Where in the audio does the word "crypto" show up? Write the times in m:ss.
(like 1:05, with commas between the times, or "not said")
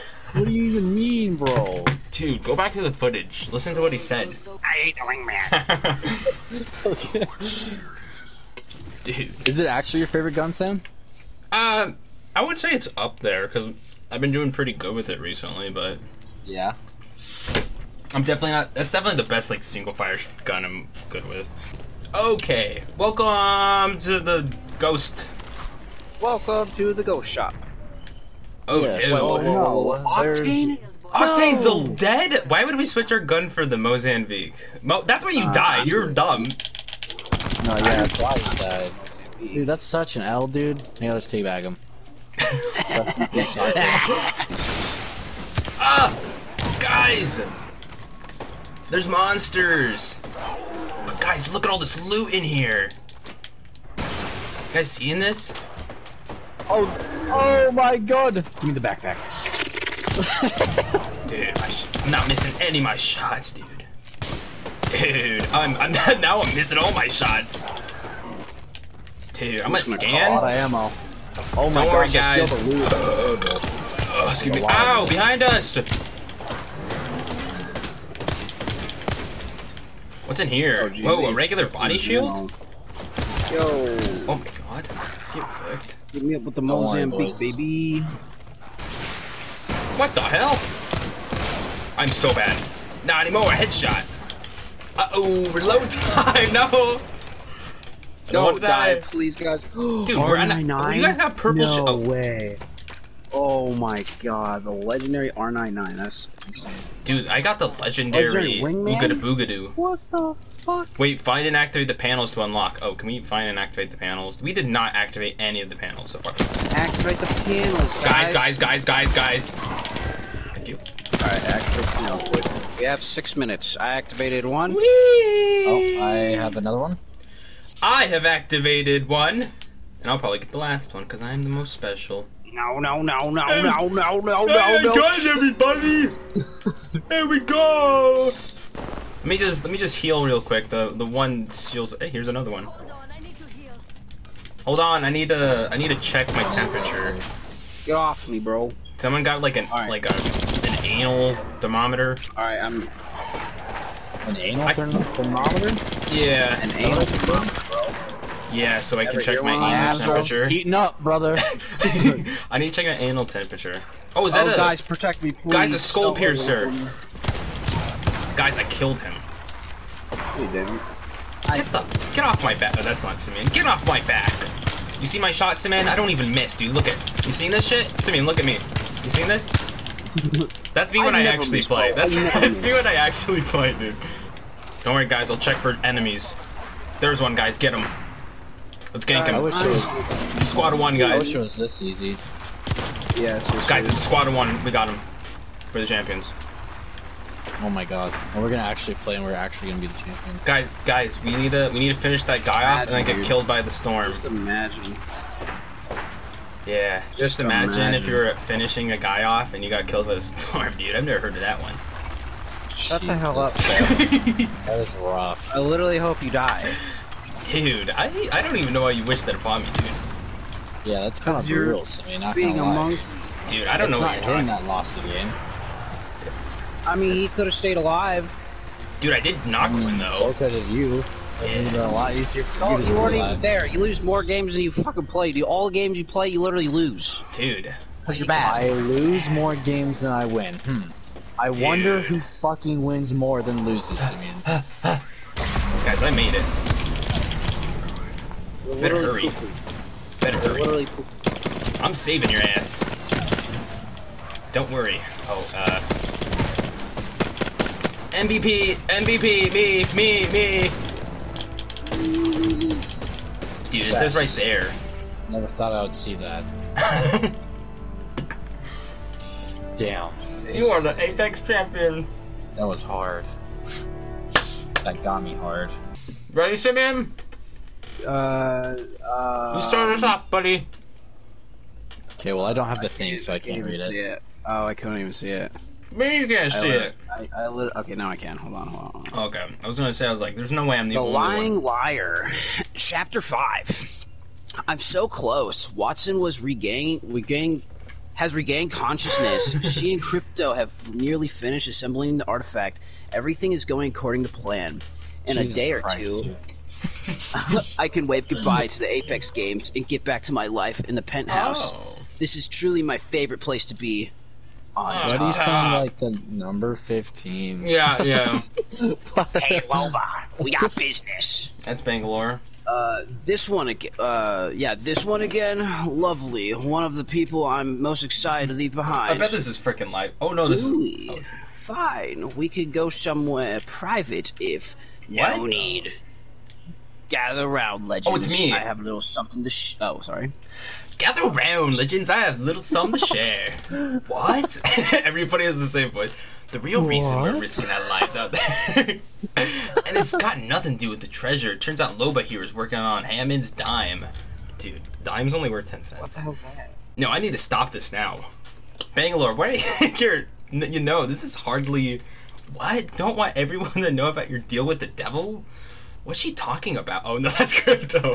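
5:00, 6:07.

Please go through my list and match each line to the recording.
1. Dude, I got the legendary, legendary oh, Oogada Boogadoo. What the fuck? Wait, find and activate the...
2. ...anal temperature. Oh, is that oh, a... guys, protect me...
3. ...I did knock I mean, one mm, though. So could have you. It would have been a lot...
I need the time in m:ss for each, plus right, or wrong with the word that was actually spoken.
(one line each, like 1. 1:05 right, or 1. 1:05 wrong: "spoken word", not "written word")
1. 1:47 right
2. 2:43 right
3. 3:49 right.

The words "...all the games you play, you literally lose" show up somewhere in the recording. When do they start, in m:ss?
3:55.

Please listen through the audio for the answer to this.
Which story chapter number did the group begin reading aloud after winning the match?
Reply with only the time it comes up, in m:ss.
4:52.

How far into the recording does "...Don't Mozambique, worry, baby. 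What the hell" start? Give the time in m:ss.
1:26.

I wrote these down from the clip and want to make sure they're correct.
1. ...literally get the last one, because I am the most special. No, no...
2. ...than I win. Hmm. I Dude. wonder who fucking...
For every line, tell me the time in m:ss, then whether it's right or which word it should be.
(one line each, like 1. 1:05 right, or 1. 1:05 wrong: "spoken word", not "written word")
1. 2:10 wrong: "probably", not "literally"
2. 4:00 right.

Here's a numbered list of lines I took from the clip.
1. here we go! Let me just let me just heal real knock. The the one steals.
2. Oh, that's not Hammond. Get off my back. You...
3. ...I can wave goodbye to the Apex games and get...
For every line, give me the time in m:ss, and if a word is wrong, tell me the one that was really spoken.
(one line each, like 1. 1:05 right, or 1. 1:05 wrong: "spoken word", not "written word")
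1. 2:17 wrong: "quick", not "knock"
2. 2:52 wrong: "Simeon", not "Hammond"
3. 5:07 right.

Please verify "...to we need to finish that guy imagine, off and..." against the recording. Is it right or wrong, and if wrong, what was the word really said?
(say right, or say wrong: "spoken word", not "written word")
right.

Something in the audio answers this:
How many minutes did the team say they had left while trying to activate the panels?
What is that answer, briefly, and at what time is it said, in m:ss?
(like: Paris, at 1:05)
6, at 2:03.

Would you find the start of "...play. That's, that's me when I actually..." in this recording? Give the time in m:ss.
3:01.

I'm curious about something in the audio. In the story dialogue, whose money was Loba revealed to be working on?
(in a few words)
Hammond.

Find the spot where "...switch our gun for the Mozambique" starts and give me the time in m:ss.
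0:32.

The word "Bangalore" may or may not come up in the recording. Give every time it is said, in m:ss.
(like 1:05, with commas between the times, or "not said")
5:21, 5:58.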